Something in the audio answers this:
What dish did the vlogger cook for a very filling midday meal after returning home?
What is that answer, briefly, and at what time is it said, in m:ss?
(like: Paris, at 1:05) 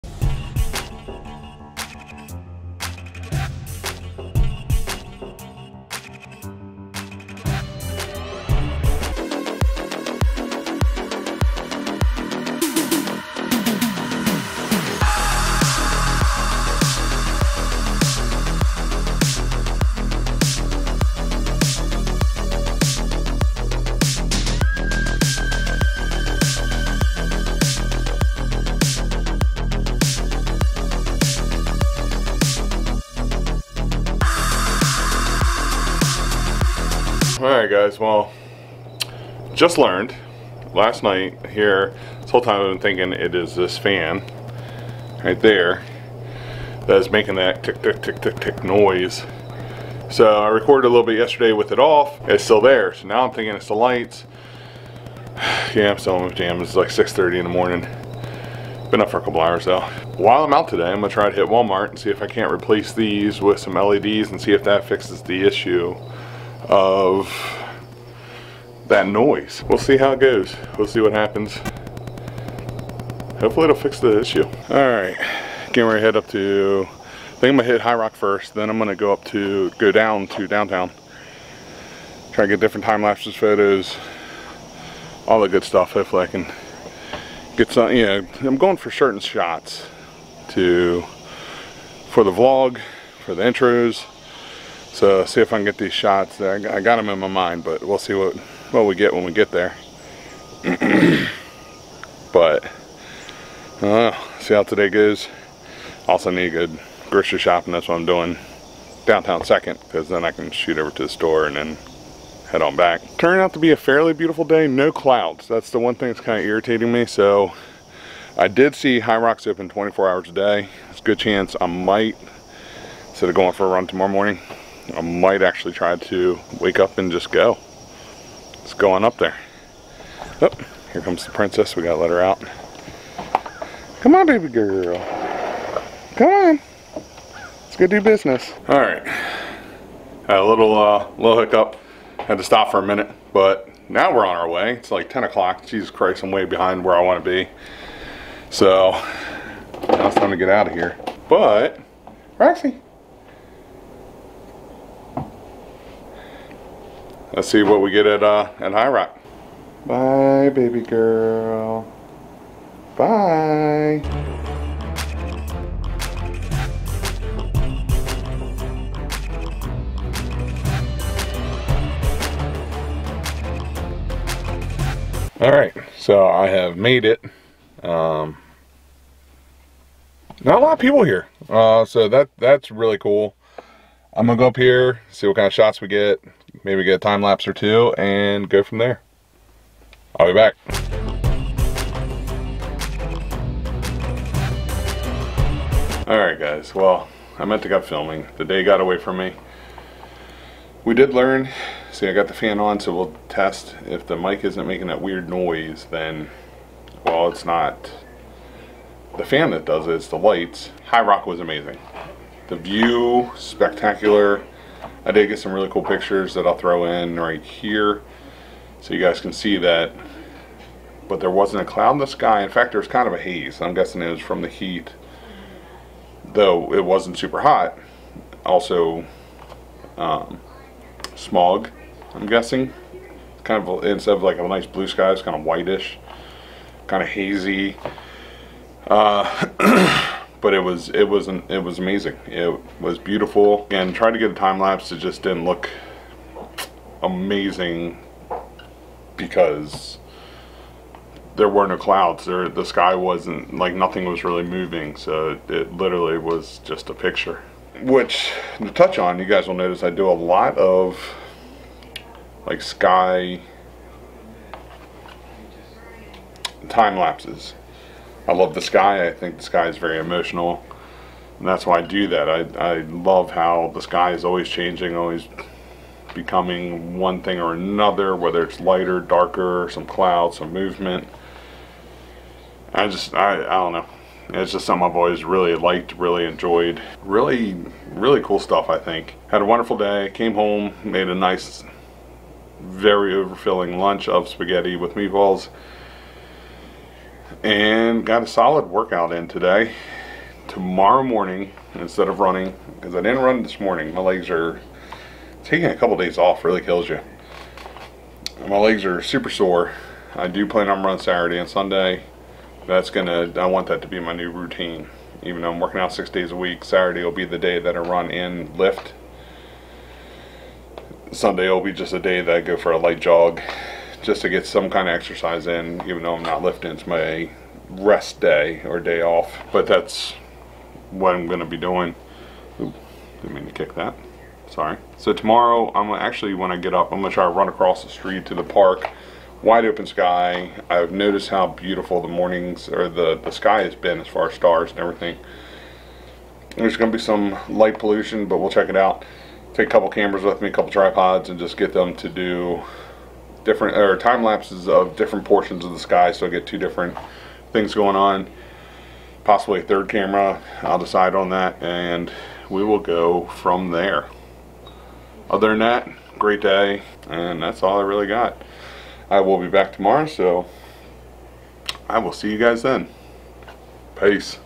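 spaghetti with meatballs, at 4:54.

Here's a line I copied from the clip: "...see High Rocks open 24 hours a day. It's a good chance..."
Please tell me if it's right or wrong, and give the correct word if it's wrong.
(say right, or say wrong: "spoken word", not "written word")
right.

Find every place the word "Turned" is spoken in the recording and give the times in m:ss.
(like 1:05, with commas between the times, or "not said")
1:53.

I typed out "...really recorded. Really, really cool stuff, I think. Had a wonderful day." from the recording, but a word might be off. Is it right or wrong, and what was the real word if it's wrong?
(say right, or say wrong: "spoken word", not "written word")
wrong: "enjoyed", not "recorded".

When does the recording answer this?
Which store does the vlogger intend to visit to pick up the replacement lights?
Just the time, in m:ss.
1:01.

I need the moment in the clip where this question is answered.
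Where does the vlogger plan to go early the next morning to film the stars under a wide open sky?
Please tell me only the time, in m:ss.
5:38.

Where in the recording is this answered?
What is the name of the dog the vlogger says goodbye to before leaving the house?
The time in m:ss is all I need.
2:32.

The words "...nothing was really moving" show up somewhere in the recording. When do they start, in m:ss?
4:13.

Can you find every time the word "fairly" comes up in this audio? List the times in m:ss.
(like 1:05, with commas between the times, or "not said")
1:53.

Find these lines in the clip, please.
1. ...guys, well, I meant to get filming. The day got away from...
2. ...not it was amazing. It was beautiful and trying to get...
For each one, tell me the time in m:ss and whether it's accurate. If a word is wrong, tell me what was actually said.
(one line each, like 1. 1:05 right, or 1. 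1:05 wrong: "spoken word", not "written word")
1. 3:16 right
2. 4:01 right.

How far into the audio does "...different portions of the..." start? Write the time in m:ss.
5:54.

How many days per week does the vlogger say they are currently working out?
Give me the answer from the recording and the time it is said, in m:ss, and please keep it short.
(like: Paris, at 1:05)
6, at 5:15.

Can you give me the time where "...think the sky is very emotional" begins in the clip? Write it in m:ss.
4:29.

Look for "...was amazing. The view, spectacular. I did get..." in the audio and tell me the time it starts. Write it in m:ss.
3:31.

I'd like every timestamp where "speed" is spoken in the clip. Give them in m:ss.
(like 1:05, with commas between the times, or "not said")
not said.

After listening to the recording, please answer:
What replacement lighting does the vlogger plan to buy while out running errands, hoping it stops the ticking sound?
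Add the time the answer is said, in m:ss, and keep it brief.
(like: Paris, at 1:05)
LEDs, at 1:03.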